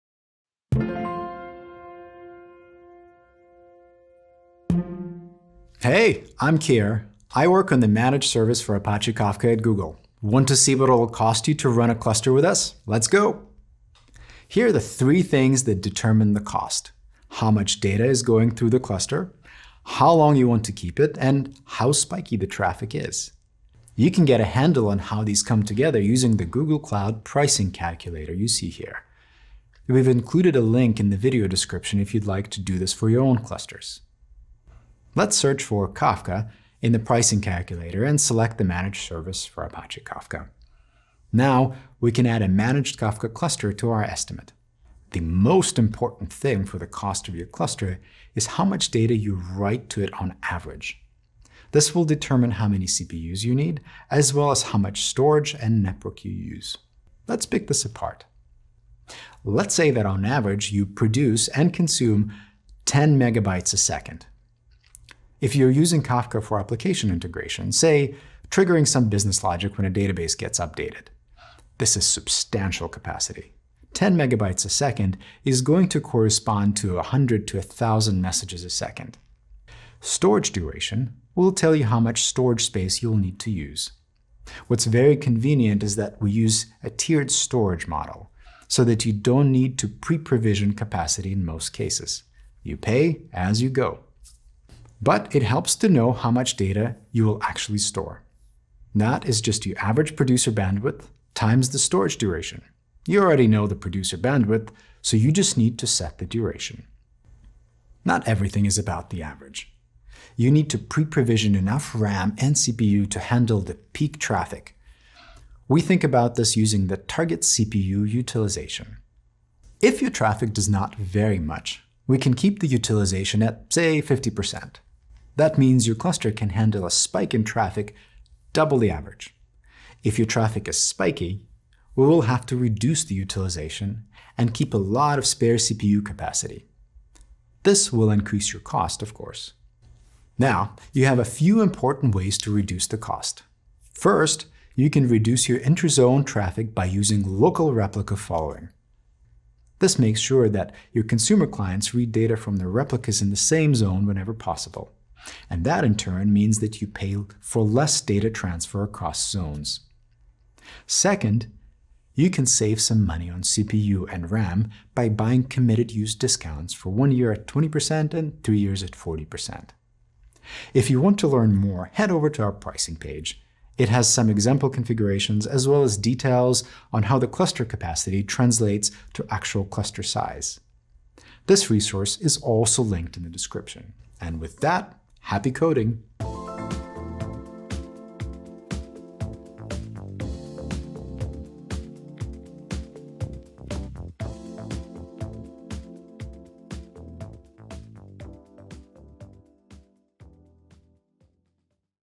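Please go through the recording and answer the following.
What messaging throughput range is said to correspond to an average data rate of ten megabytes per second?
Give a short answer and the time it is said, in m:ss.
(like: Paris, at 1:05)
100 to 1,000 messages a second, at 1:16.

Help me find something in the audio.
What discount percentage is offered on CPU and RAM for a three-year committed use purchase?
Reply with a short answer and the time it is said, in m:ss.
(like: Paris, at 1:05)
40%, at 2:48.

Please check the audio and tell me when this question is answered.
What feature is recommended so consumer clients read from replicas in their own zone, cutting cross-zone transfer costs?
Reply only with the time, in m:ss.
2:27.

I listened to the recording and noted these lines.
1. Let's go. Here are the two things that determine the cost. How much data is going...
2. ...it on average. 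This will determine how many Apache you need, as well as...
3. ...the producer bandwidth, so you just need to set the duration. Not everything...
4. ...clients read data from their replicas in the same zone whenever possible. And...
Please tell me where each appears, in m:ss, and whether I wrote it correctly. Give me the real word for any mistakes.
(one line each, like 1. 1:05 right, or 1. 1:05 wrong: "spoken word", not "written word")
1. 0:12 wrong: "three", not "two"
2. 0:50 wrong: "CPUs", not "Apache"
3. 1:43 right
4. 2:31 right.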